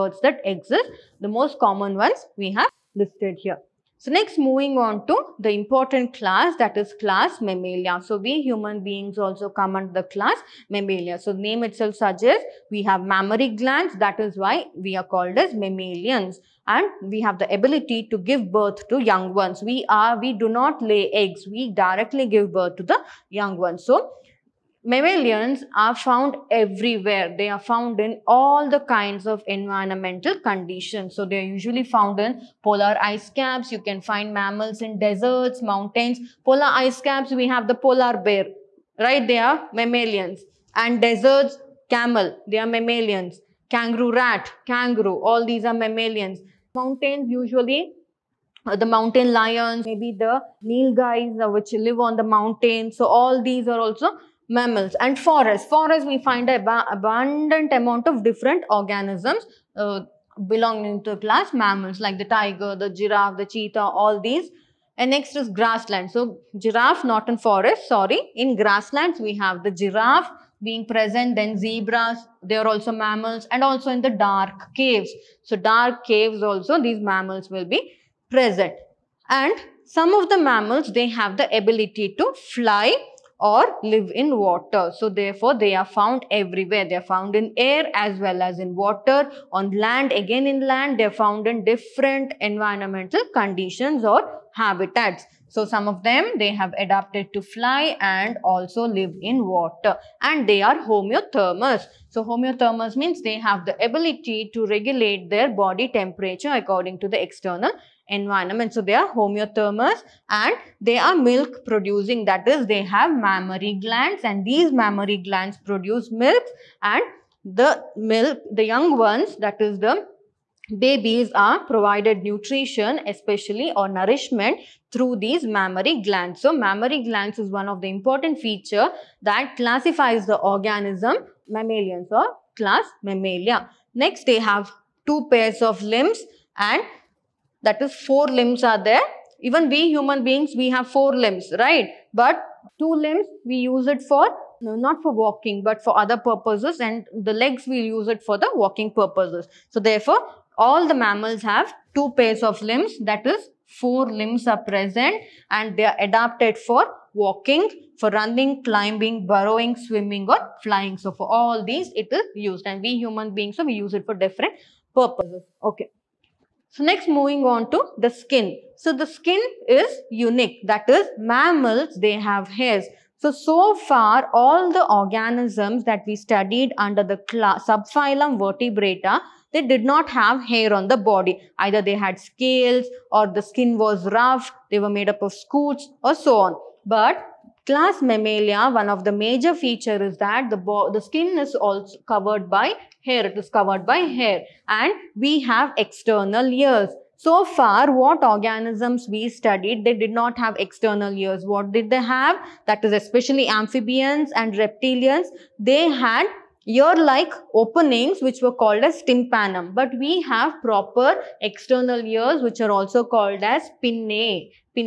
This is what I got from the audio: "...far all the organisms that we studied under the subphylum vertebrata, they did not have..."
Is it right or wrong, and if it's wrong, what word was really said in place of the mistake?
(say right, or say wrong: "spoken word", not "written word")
right.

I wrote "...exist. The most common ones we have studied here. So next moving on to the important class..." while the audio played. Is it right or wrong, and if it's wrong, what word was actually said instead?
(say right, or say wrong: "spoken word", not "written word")
wrong: "listed", not "studied".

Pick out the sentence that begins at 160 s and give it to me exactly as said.
So for all these, it is used and we human beings, so we use it for different purposes.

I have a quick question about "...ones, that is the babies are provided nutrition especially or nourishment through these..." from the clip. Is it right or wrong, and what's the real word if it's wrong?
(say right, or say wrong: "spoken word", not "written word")
right.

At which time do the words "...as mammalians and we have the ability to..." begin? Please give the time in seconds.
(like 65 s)
15 s.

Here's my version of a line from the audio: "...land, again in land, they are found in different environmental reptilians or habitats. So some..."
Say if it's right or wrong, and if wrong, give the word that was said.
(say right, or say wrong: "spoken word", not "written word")
wrong: "conditions", not "reptilians".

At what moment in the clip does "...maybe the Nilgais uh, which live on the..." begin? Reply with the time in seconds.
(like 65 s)
49 s.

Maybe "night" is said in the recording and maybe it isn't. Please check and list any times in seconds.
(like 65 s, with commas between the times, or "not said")
not said.